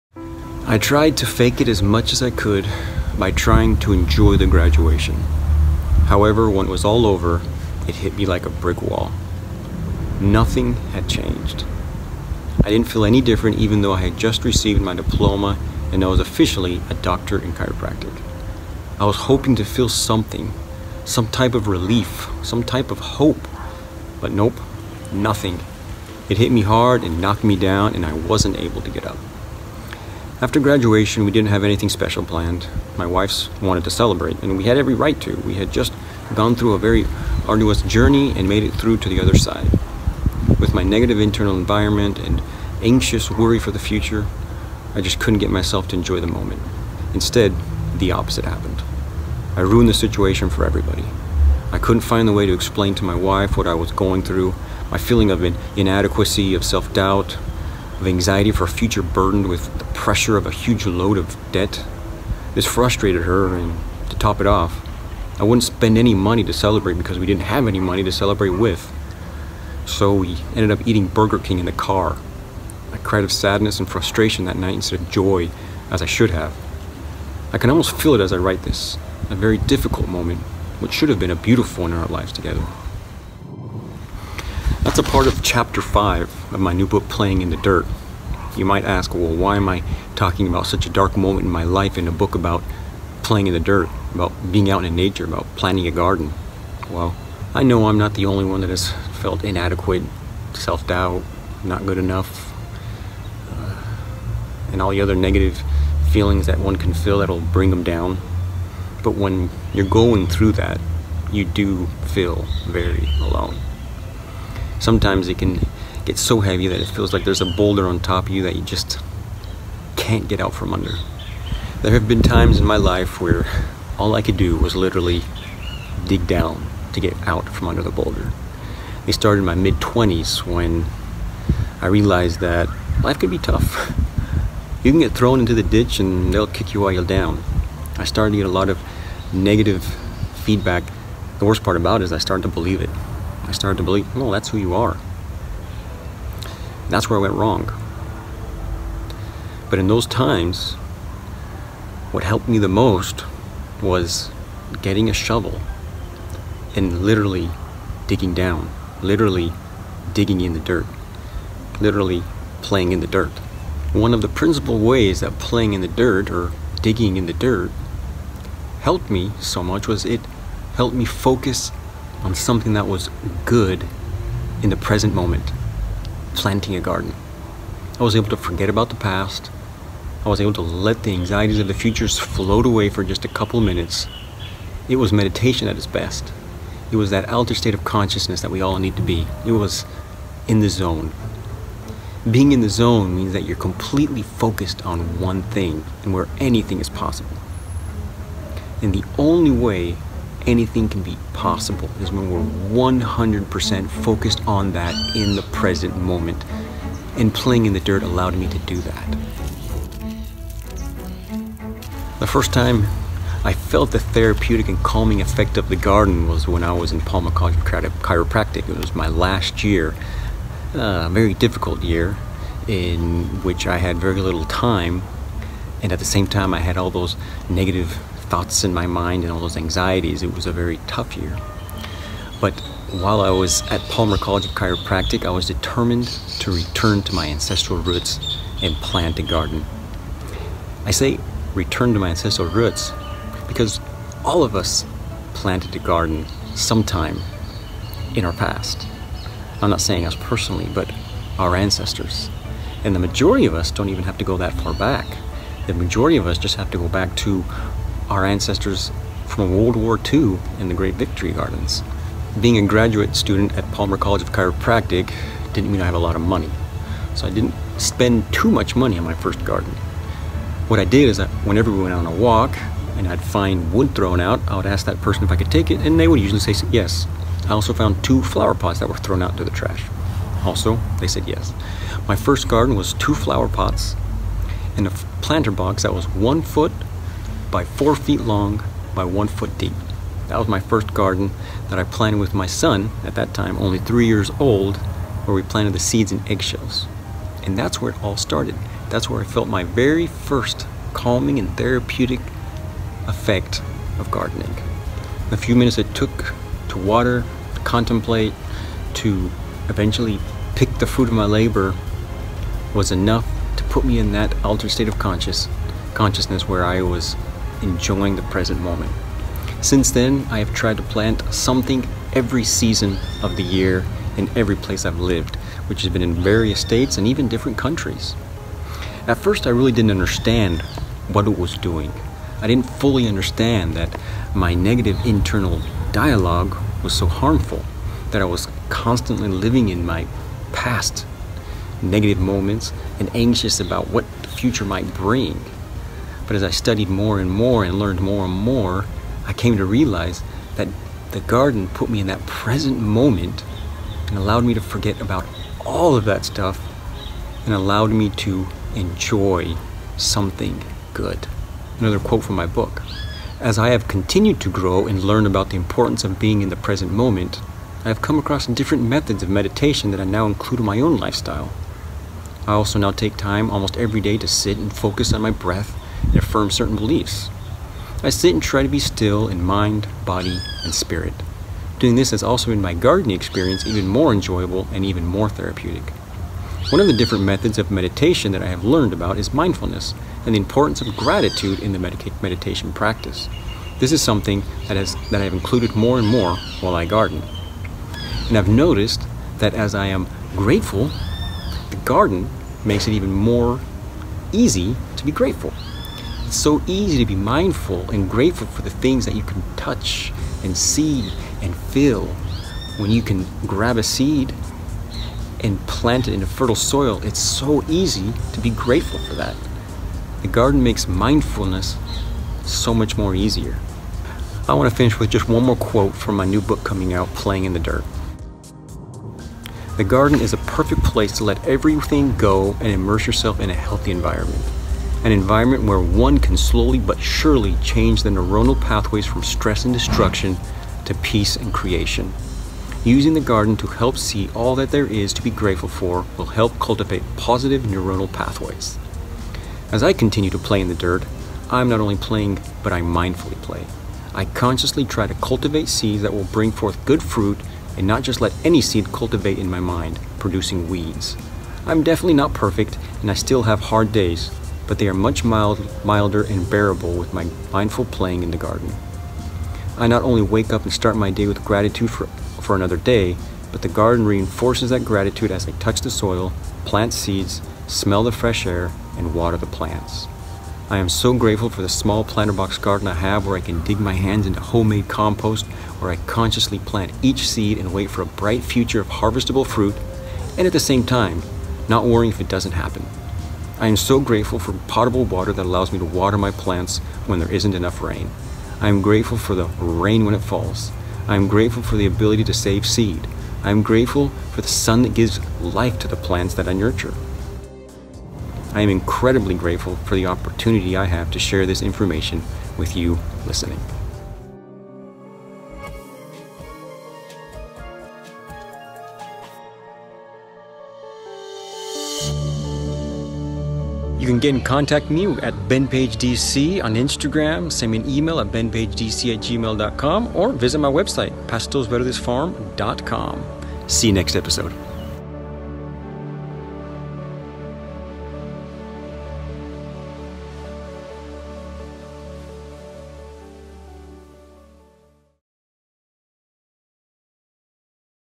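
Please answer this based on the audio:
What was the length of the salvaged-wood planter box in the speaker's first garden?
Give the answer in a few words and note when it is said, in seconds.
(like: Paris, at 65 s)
4 feet, at 287 s.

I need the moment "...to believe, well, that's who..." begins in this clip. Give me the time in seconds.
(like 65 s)
143 s.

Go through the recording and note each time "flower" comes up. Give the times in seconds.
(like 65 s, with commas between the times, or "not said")
278 s, 283 s.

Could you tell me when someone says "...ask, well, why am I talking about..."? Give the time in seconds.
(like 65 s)
88 s.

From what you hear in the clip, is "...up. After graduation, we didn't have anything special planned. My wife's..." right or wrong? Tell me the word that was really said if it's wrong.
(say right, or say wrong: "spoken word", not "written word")
right.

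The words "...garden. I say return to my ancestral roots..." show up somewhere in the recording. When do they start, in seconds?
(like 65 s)
239 s.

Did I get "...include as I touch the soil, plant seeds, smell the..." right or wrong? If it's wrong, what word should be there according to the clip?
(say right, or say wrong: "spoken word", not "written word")
wrong: "gratitude", not "include".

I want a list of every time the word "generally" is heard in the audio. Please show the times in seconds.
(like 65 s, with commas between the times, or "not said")
not said.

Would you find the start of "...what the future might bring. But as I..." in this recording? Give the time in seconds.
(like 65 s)
343 s.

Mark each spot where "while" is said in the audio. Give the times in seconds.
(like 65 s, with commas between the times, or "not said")
136 s, 233 s, 396 s.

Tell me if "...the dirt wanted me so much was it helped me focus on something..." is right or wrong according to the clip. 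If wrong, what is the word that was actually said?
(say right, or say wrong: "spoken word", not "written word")
wrong: "helped", not "wanted".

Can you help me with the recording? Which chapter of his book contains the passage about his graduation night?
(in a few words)
5.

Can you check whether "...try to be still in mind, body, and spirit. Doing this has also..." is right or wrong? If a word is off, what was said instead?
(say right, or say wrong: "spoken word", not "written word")
right.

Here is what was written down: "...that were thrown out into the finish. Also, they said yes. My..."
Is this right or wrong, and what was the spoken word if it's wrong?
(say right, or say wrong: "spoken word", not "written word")
wrong: "trash", not "finish".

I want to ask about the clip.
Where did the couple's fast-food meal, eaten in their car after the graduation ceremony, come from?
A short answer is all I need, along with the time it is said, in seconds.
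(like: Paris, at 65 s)
Burger King, at 71 s.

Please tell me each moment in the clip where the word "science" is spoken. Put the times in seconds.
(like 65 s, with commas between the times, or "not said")
not said.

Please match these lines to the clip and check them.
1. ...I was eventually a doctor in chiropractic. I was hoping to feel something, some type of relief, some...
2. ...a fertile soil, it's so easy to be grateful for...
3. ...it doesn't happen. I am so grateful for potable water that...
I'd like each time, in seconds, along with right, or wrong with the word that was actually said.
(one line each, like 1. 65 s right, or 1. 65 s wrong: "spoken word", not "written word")
1. 16 s wrong: "officially", not "eventually"
2. 416 s right
3. 492 s right.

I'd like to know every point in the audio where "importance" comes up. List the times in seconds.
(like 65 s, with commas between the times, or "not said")
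365 s, 390 s.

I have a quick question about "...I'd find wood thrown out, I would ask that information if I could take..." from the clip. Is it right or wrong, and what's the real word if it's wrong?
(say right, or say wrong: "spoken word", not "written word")
wrong: "person", not "information".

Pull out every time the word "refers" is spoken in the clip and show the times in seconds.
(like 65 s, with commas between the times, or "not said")
not said.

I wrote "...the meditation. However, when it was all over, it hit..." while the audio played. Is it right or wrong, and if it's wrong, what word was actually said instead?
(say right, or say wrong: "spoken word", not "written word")
wrong: "graduation", not "meditation".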